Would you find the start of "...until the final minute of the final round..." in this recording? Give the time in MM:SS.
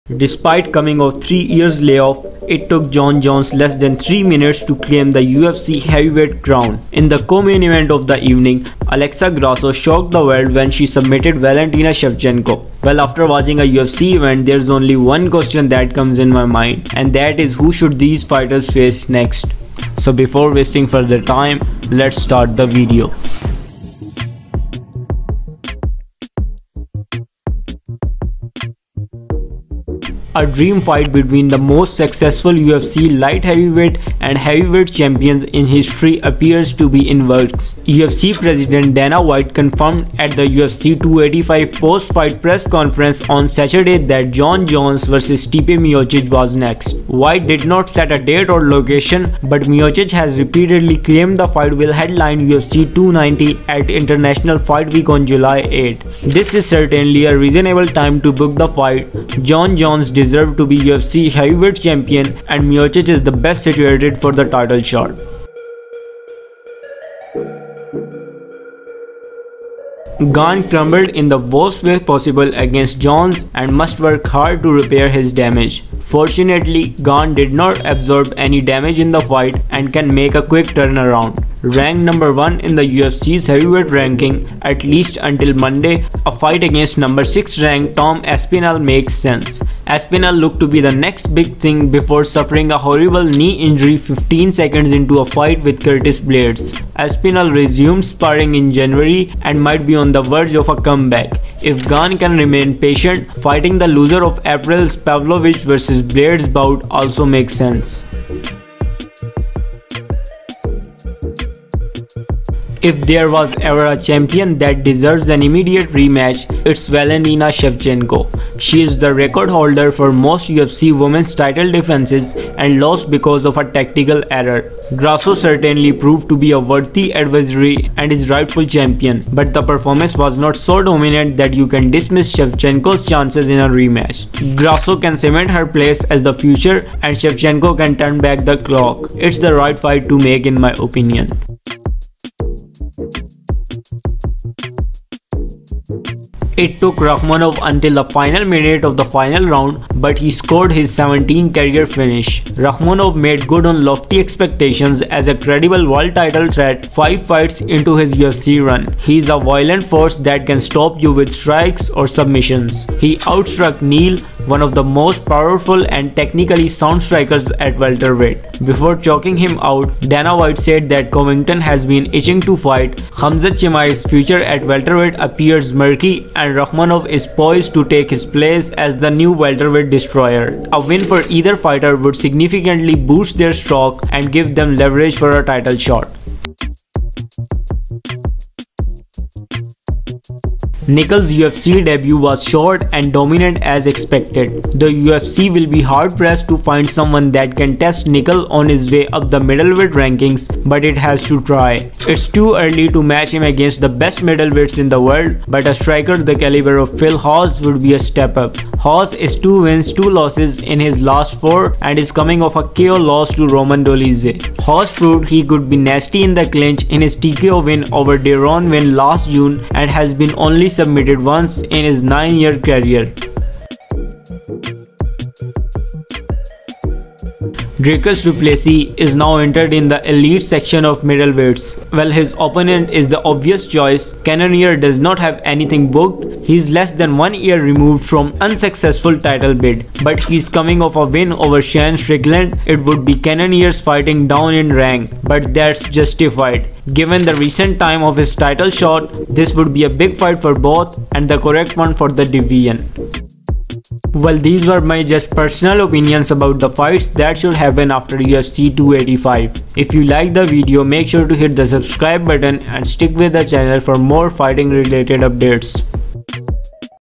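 02:27.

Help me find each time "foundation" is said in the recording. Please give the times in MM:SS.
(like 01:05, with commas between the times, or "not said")
not said.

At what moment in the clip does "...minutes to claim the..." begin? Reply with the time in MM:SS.
00:04.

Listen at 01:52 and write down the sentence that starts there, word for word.
If there was ever a champion that deserves an immediate rematch, it's Valentina Shevchenko.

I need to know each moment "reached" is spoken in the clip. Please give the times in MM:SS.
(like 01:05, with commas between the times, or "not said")
not said.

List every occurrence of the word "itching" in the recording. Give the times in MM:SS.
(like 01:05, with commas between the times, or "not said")
02:52.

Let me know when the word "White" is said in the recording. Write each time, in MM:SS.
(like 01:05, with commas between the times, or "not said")
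00:39, 00:47, 02:50.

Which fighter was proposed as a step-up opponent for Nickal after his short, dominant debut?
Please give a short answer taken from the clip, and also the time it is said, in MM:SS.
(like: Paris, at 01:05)
Phil Hawes, at 03:26.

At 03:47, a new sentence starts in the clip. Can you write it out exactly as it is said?
Dricus Du Plessis is now entered in the elite section of middleweights.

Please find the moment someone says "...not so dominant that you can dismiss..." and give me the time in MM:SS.
02:10.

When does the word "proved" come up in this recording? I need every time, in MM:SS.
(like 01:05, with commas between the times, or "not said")
02:05, 03:34.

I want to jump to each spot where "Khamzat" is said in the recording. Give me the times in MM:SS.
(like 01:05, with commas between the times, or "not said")
02:53.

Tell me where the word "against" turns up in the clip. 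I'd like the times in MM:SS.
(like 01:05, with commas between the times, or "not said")
01:12, 01:26, 03:23.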